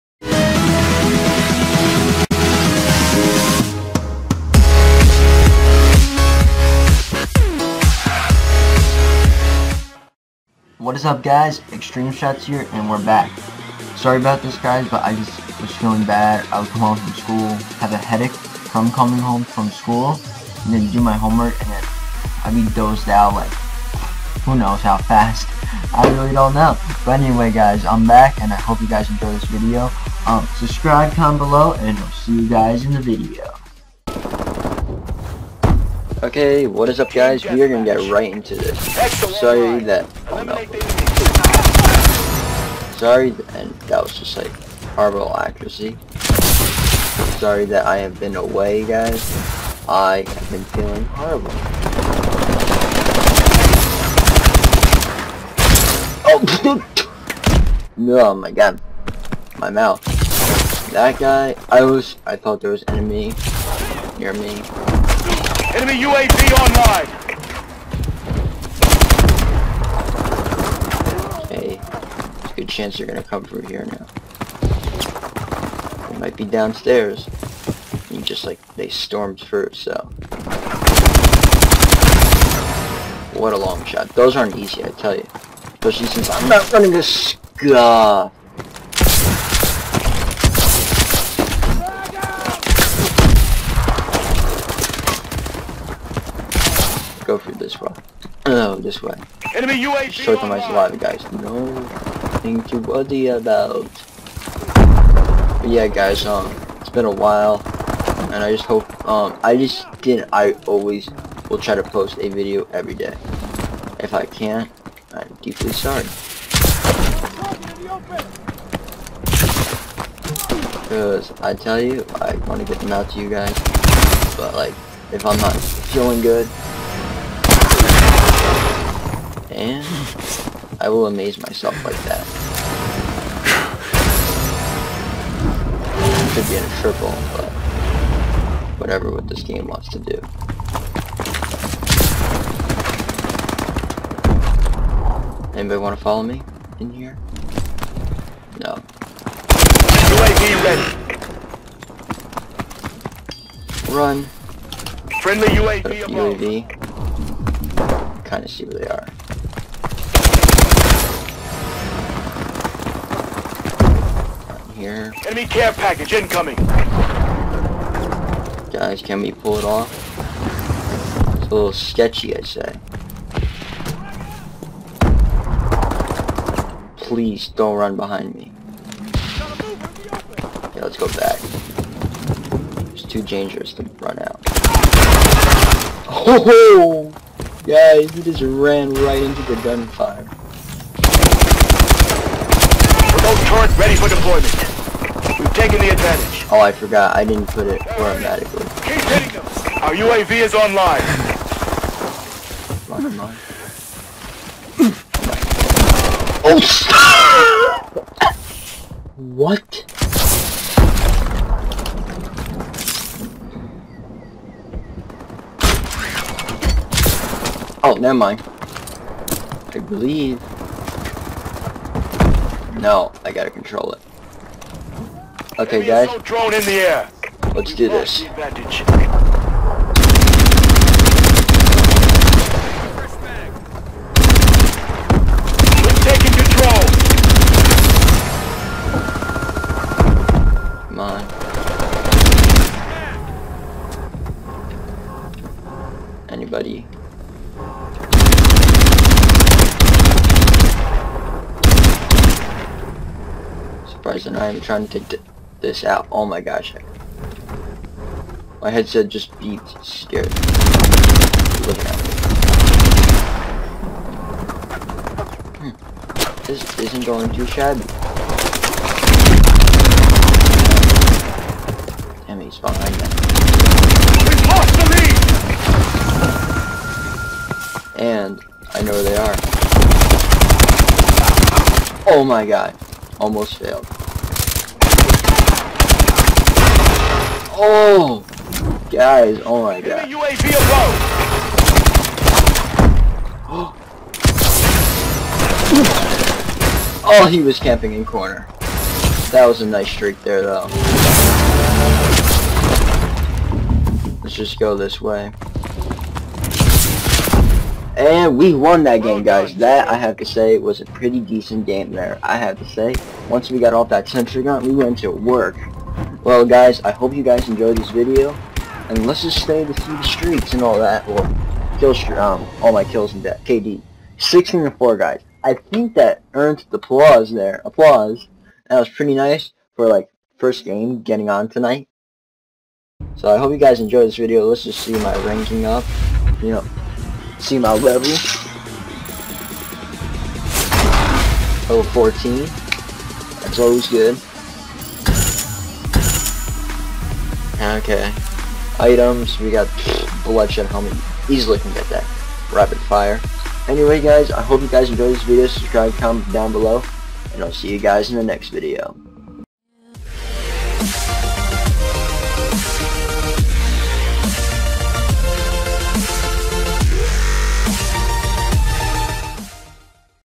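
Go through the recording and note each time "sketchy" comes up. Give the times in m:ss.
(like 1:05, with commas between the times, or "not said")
2:51.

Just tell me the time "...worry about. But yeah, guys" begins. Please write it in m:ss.
1:42.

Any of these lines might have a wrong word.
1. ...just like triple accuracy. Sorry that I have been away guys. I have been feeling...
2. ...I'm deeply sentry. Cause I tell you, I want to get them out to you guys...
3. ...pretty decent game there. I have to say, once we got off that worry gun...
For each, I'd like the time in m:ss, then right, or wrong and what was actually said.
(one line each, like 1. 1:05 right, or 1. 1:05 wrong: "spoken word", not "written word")
1. 0:44 wrong: "horrible", not "triple"
2. 1:55 wrong: "sorry", not "sentry"
3. 5:10 wrong: "sentry", not "worry".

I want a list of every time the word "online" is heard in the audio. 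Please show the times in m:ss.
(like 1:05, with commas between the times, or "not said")
1:06, 3:20.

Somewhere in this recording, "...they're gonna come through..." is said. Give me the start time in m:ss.
1:12.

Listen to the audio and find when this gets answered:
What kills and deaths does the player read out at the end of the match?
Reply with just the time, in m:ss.
5:24.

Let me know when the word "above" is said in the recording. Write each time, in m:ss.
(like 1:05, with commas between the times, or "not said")
4:50.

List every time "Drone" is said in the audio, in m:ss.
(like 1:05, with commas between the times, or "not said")
3:46.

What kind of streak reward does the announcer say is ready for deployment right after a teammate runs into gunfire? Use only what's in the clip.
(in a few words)
Assault turret.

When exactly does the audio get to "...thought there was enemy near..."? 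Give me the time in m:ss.
1:02.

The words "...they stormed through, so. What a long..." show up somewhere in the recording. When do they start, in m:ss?
1:18.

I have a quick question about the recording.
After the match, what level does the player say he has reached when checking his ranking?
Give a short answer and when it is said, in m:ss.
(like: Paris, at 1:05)
14, at 5:41.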